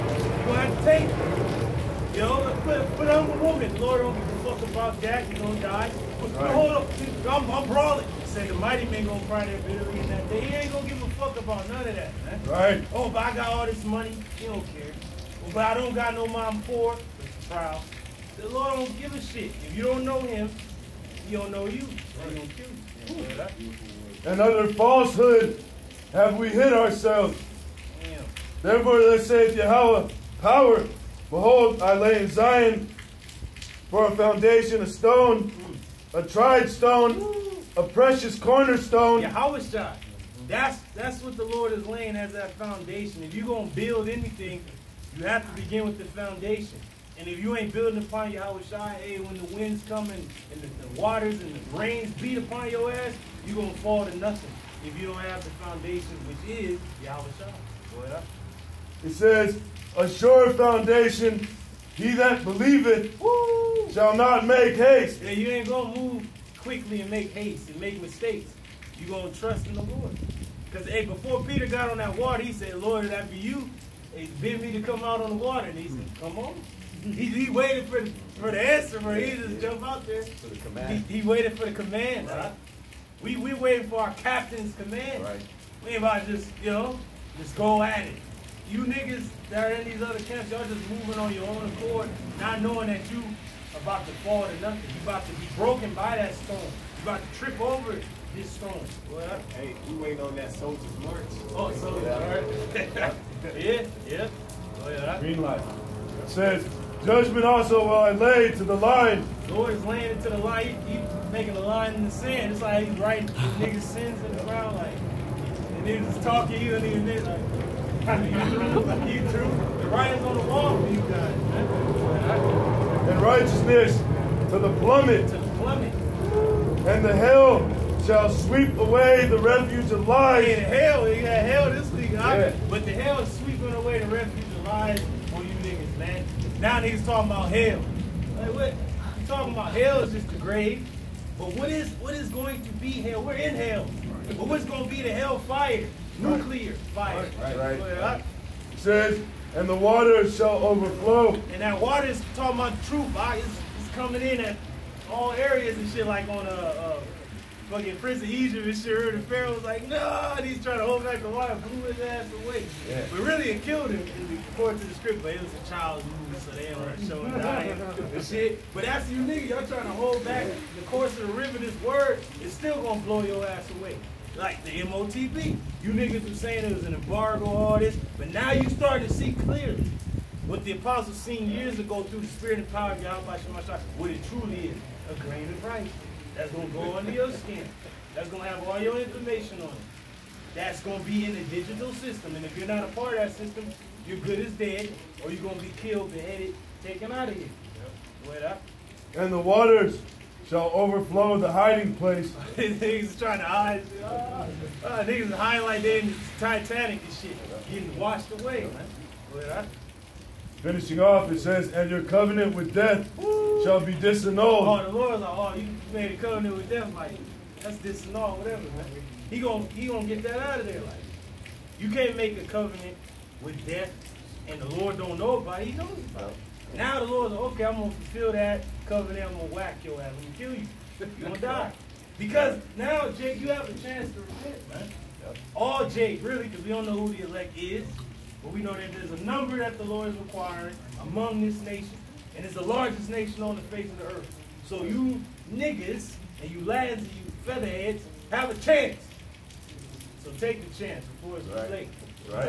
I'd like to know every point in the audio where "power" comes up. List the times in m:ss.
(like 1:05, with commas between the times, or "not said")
0:30, 3:02.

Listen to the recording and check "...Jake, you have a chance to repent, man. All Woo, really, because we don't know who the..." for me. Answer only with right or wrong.
wrong.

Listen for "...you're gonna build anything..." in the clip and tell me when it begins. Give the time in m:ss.
0:43.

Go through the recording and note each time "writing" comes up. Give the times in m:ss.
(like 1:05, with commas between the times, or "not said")
1:52, 1:59.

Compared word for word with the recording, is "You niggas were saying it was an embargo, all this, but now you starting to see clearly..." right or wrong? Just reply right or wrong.
right.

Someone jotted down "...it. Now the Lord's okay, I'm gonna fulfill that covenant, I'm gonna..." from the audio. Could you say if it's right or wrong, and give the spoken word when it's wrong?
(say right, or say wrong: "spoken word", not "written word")
right.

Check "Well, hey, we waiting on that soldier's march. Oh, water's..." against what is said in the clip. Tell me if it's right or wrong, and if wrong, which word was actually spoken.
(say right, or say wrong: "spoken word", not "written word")
wrong: "soldier", not "water".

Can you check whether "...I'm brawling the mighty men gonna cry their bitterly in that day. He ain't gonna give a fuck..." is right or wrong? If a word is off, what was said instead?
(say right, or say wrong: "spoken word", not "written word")
right.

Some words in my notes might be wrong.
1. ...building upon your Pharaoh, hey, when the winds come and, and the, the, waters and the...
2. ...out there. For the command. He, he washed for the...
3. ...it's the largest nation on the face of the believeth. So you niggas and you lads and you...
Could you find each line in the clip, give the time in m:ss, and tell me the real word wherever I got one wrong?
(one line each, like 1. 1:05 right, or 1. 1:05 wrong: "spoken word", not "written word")
1. 0:47 wrong: "Yahawashah", not "Pharaoh"
2. 1:19 wrong: "waited", not "washed"
3. 4:02 wrong: "earth", not "believeth".